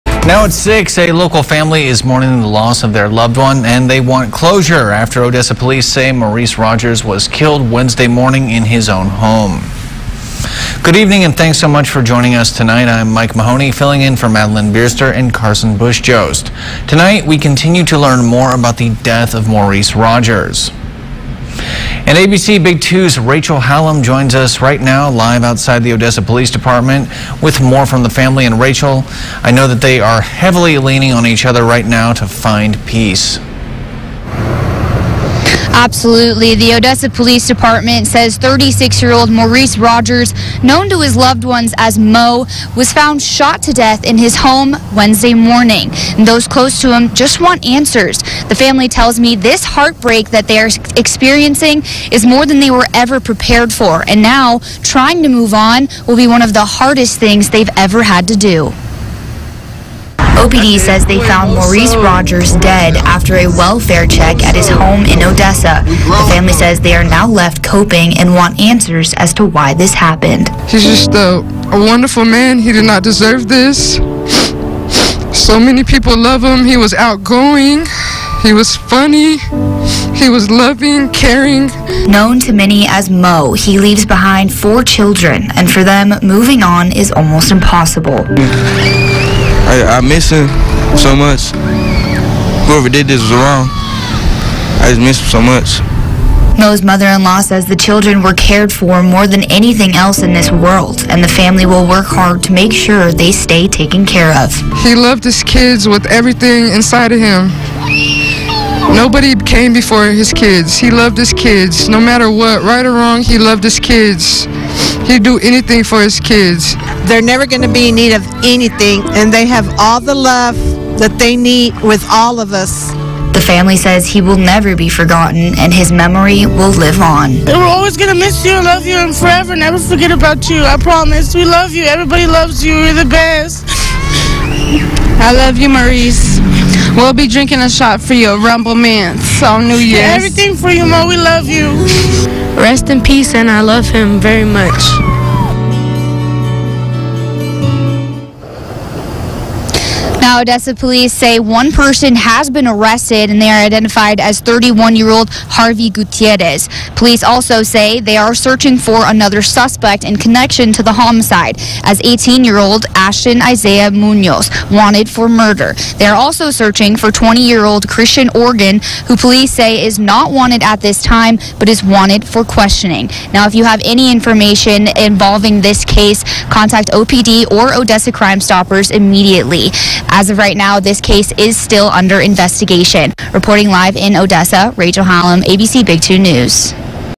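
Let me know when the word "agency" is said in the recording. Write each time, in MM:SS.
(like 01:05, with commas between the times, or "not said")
not said.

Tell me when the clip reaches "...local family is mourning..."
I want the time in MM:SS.
00:01.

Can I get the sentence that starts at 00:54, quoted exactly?
And now, trying to move on will be one of the hardest things they've ever had to do.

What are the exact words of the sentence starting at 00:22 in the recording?
And ABC Big 2's Rachel Hallam joins us right now live outside the Odessa Police Department with more from the family.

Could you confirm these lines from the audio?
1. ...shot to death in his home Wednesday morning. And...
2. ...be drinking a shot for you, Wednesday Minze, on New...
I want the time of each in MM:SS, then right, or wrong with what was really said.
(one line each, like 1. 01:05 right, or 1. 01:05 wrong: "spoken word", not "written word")
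1. 00:43 right
2. 02:17 wrong: "Rumple", not "Wednesday".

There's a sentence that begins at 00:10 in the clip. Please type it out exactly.
Good evening and thanks so much for joining us tonight.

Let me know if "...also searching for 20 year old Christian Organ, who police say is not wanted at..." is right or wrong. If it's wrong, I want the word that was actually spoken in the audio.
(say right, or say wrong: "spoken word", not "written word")
right.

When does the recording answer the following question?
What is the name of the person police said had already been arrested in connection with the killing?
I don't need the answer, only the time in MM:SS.
02:35.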